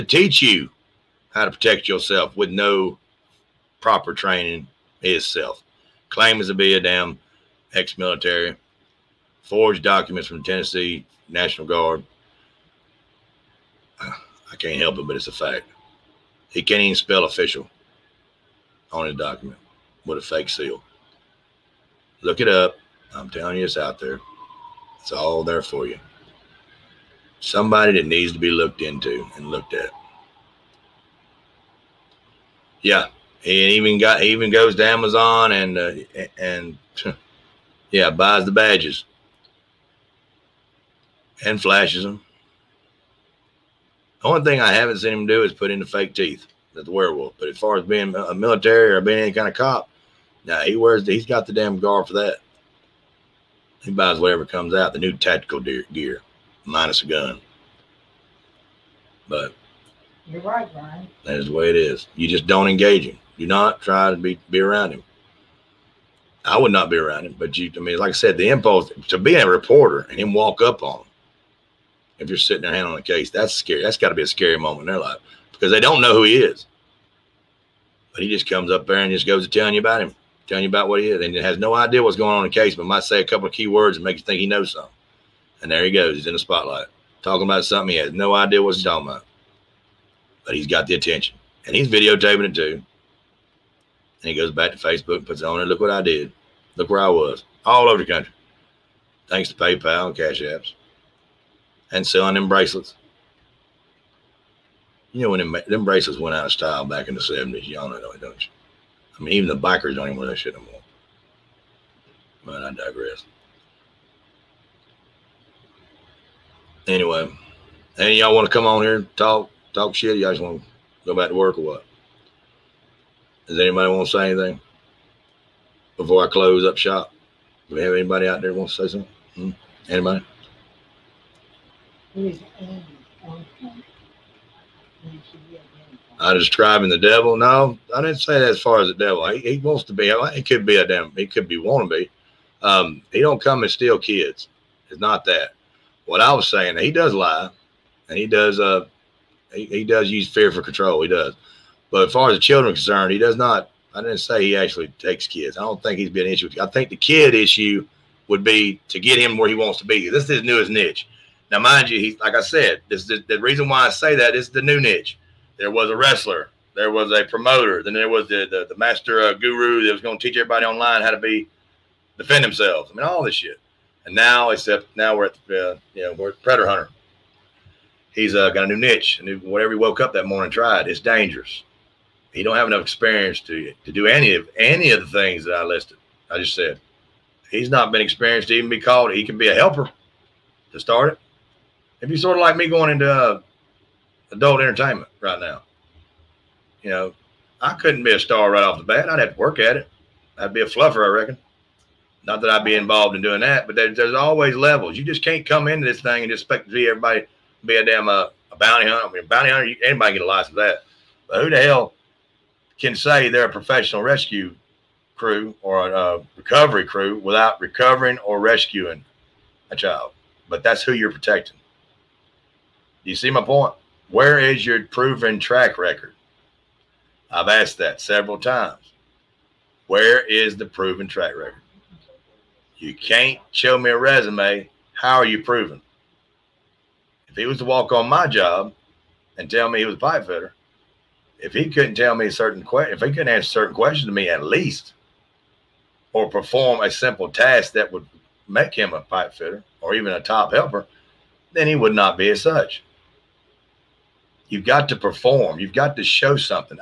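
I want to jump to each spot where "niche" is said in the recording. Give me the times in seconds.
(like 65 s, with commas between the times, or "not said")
160 s, 164 s, 178 s.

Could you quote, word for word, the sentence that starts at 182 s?
He don't have enough experience to to do any of any of the things that I listed.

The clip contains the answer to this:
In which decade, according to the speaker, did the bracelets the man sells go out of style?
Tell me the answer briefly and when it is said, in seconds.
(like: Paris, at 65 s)
the 70s, at 107 s.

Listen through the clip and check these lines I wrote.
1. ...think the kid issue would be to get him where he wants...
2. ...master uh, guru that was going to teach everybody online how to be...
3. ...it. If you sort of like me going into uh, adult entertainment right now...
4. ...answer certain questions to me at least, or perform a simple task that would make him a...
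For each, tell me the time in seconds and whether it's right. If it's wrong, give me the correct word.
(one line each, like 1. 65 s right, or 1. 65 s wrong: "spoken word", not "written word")
1. 156 s right
2. 168 s right
3. 191 s right
4. 243 s right.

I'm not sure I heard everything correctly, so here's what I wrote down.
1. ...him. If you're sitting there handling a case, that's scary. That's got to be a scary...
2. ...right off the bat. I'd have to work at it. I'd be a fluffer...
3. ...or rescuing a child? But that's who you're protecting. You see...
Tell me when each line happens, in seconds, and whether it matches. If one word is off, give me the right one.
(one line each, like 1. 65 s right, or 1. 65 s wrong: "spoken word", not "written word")
1. 71 s right
2. 198 s right
3. 218 s right.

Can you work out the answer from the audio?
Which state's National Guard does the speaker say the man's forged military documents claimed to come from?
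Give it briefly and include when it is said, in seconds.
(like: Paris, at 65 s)
Tennessee, at 10 s.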